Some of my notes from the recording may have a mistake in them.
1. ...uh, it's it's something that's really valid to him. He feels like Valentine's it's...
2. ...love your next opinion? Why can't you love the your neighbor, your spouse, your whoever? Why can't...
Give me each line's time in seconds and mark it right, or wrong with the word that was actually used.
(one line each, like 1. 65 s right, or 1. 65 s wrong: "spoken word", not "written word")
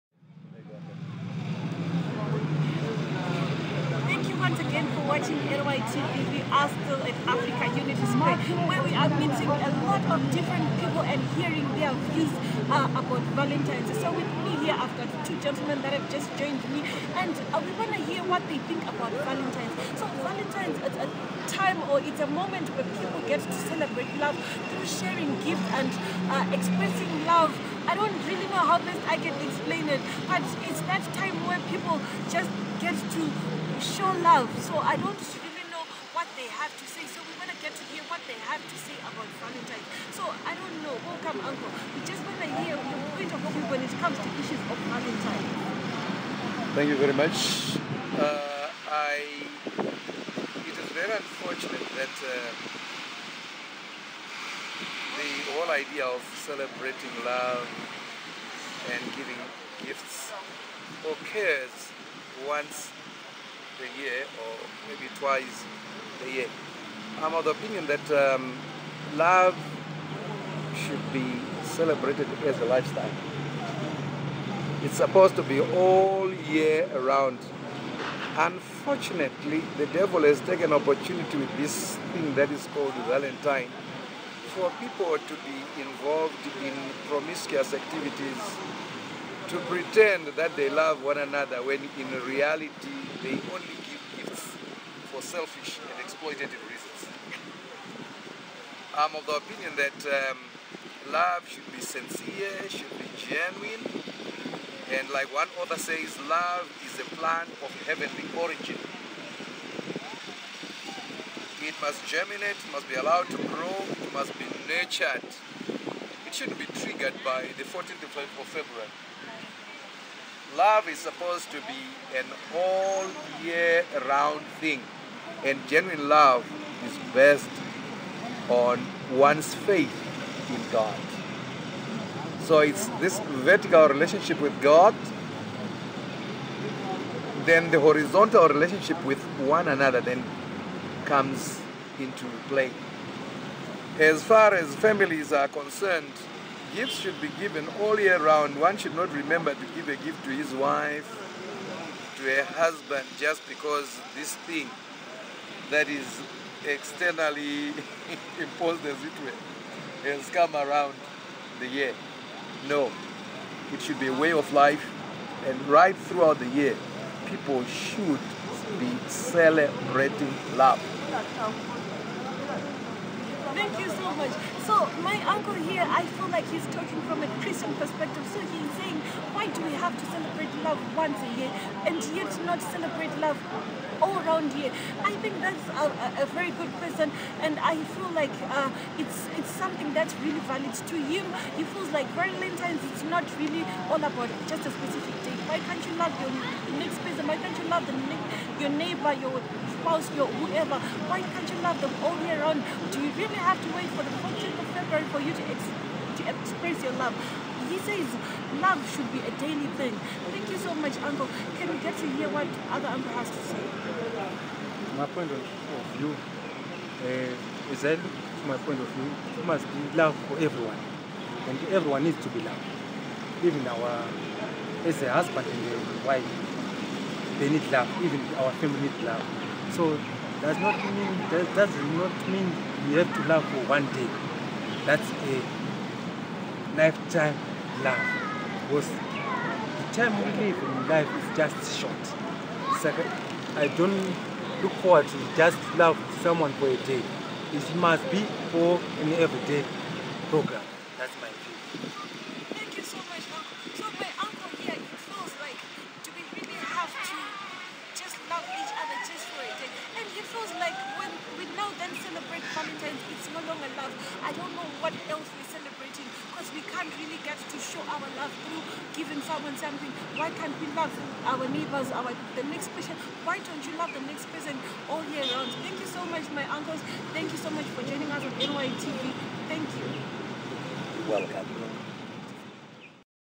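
1. 188 s right
2. 196 s wrong: "person", not "opinion".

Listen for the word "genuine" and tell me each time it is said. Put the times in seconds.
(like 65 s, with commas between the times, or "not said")
103 s, 125 s.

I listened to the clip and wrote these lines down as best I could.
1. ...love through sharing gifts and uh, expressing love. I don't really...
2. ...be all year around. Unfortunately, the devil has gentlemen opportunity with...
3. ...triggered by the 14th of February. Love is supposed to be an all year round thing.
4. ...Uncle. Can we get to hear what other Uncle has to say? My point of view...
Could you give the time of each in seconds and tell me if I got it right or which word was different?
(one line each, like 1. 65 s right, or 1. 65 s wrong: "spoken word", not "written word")
1. 24 s right
2. 75 s wrong: "taken", not "gentlemen"
3. 116 s right
4. 211 s right.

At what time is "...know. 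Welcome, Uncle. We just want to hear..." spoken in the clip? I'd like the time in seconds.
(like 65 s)
40 s.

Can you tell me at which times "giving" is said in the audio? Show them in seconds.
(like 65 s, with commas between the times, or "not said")
59 s, 268 s.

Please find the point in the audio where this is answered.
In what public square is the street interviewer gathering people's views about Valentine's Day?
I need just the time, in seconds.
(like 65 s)
6 s.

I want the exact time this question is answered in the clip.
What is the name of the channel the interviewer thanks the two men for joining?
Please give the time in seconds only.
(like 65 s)
278 s.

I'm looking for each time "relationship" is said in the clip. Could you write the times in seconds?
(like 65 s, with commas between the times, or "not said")
133 s, 138 s.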